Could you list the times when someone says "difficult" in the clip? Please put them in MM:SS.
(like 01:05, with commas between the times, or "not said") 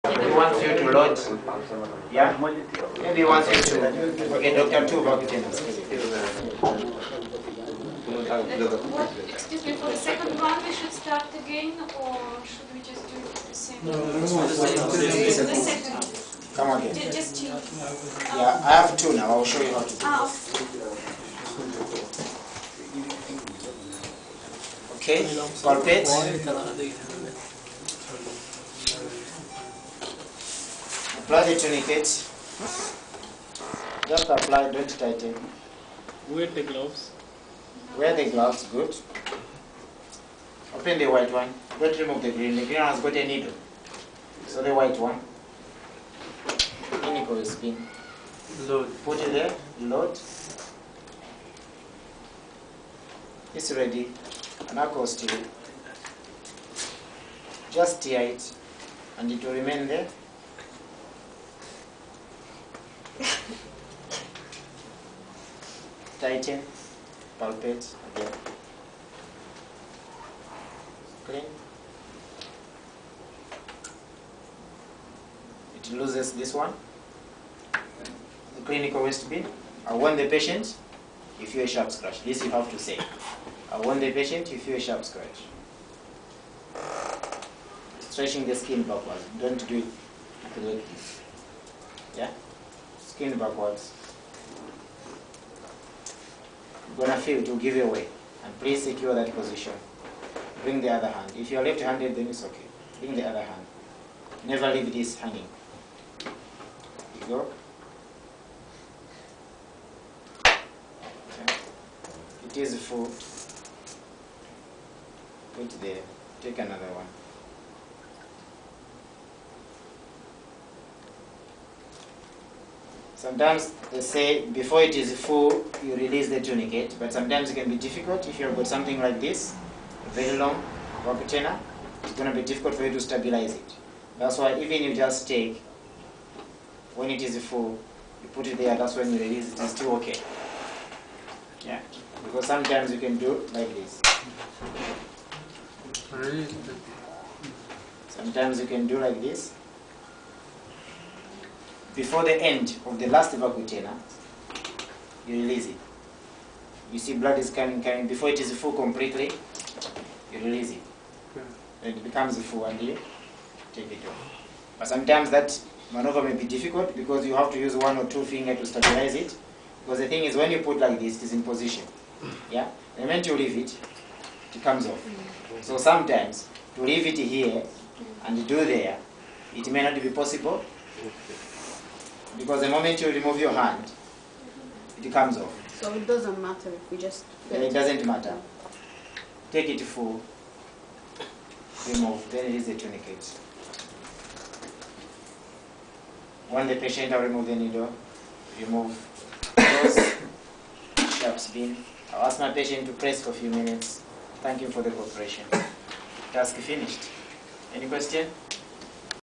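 02:07, 02:12, 02:46.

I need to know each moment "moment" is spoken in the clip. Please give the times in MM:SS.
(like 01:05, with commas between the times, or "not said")
02:53, 03:02.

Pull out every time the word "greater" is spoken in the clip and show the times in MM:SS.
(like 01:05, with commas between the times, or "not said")
not said.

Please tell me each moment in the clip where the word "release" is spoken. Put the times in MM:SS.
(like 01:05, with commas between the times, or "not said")
02:05, 02:19, 02:35, 02:40.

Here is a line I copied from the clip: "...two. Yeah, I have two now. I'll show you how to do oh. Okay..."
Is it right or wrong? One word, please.
right.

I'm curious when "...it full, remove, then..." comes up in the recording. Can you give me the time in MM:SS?
03:09.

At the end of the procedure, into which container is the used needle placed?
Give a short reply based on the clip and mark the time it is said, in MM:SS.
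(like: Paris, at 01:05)
Sharps bin, at 03:21.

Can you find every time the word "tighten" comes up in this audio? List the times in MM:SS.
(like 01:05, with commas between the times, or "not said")
00:34, 01:06.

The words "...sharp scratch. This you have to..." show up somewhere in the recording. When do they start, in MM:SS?
01:21.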